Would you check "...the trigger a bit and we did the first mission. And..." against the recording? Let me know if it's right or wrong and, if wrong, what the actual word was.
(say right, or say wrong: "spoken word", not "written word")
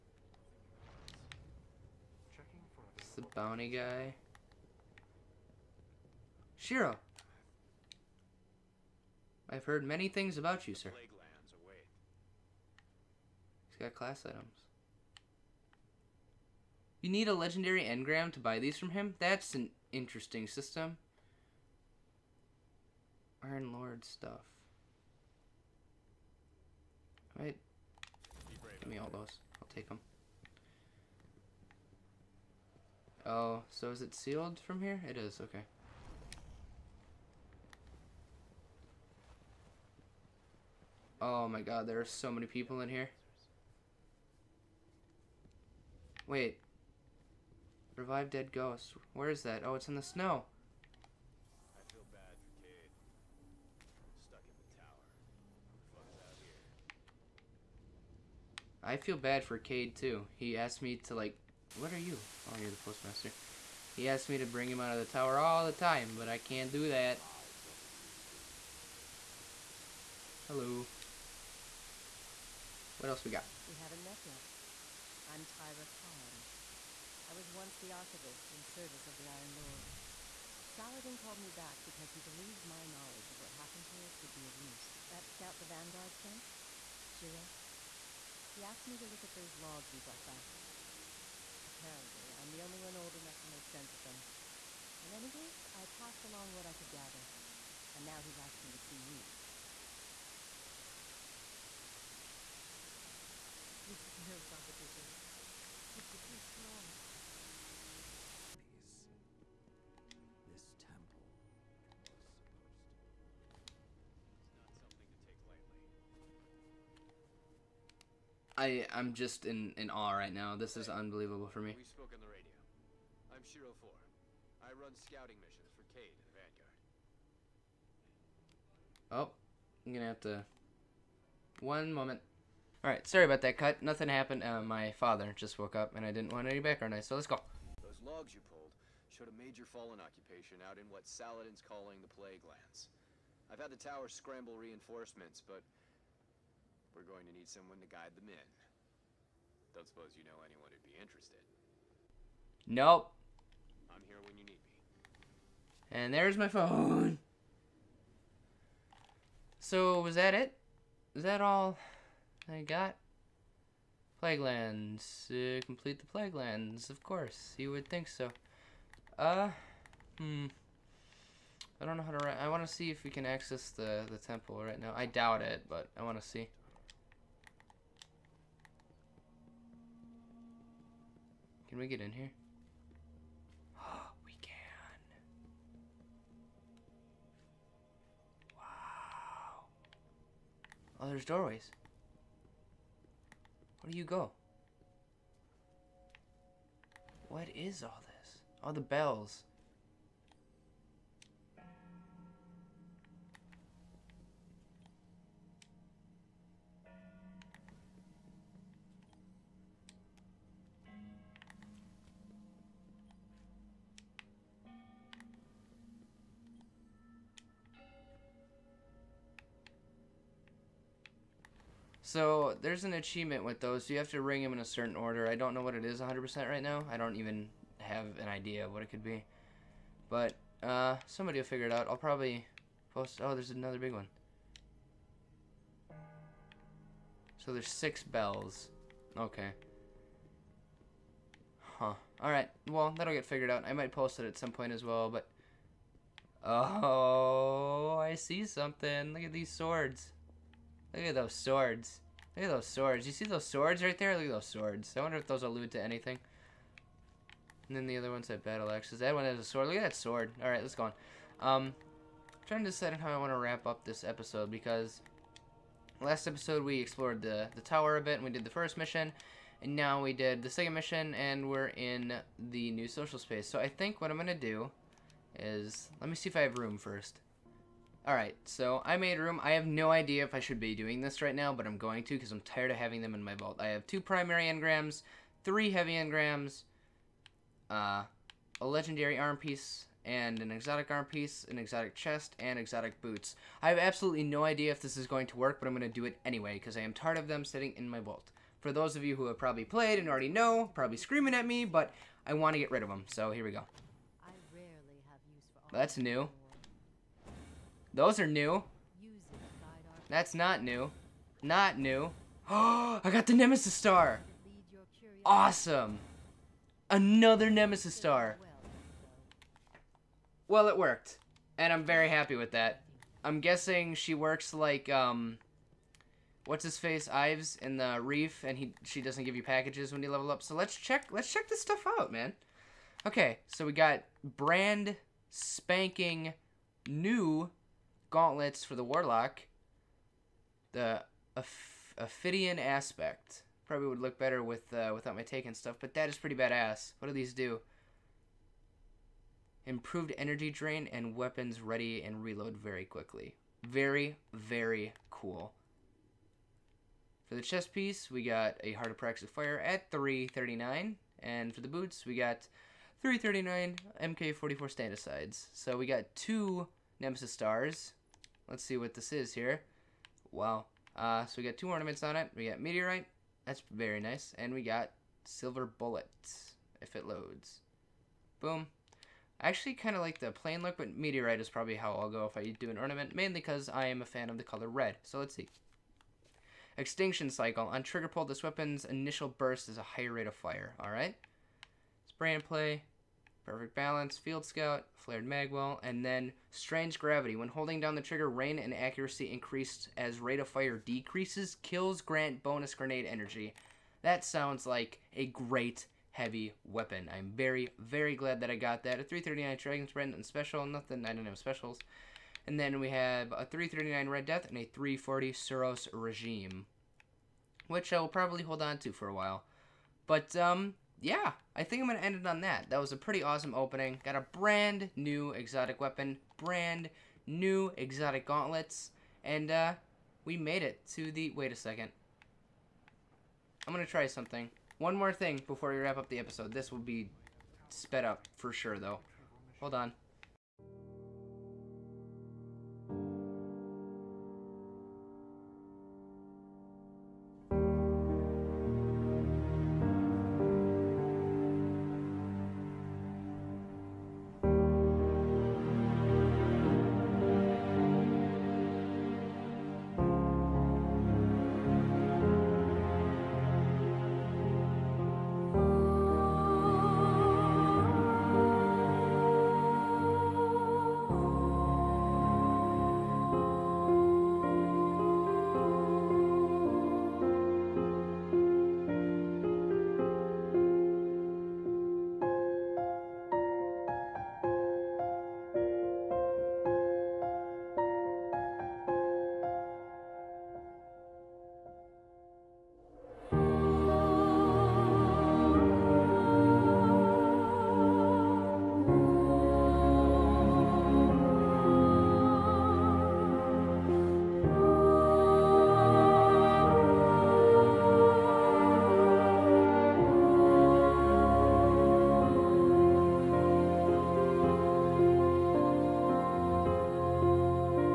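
wrong: "tower", not "trigger".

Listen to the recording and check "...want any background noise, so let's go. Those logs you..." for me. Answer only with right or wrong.
right.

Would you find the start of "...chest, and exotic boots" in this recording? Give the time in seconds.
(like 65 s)
291 s.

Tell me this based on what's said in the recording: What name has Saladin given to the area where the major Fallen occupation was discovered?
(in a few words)
Plague Lands.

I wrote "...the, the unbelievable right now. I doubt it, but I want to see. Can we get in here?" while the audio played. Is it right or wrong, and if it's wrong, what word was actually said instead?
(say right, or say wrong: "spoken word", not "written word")
wrong: "temple", not "unbelievable".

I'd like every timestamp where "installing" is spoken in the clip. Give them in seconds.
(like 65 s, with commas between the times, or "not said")
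not said.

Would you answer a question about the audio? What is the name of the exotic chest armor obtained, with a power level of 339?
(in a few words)
Heart of Praxis Fire.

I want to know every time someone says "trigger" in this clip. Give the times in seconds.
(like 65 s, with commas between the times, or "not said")
387 s, 398 s.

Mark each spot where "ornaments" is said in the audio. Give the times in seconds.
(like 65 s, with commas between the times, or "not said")
371 s, 382 s.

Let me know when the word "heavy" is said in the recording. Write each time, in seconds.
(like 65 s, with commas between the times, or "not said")
285 s, 406 s.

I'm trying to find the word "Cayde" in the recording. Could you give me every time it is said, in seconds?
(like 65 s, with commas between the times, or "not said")
59 s, 125 s.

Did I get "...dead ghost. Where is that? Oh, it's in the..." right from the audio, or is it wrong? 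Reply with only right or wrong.
right.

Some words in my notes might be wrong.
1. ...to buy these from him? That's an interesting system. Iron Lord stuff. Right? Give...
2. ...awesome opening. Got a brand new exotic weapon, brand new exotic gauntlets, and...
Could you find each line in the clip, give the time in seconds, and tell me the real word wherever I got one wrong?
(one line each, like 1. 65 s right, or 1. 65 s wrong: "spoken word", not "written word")
1. 18 s right
2. 423 s right.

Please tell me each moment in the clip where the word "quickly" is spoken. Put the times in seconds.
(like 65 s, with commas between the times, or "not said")
352 s.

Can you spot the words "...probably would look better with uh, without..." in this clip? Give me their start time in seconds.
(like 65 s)
343 s.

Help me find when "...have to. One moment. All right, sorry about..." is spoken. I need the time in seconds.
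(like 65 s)
130 s.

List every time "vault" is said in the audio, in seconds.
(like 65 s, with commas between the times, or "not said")
283 s, 297 s.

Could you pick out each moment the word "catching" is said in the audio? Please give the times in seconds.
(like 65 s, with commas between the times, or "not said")
not said.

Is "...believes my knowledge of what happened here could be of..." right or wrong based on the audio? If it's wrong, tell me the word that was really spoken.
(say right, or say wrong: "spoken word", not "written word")
right.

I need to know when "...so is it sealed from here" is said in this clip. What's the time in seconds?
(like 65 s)
33 s.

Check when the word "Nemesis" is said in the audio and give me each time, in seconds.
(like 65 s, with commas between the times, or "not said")
313 s, 317 s, 366 s.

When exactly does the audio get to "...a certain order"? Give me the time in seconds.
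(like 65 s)
224 s.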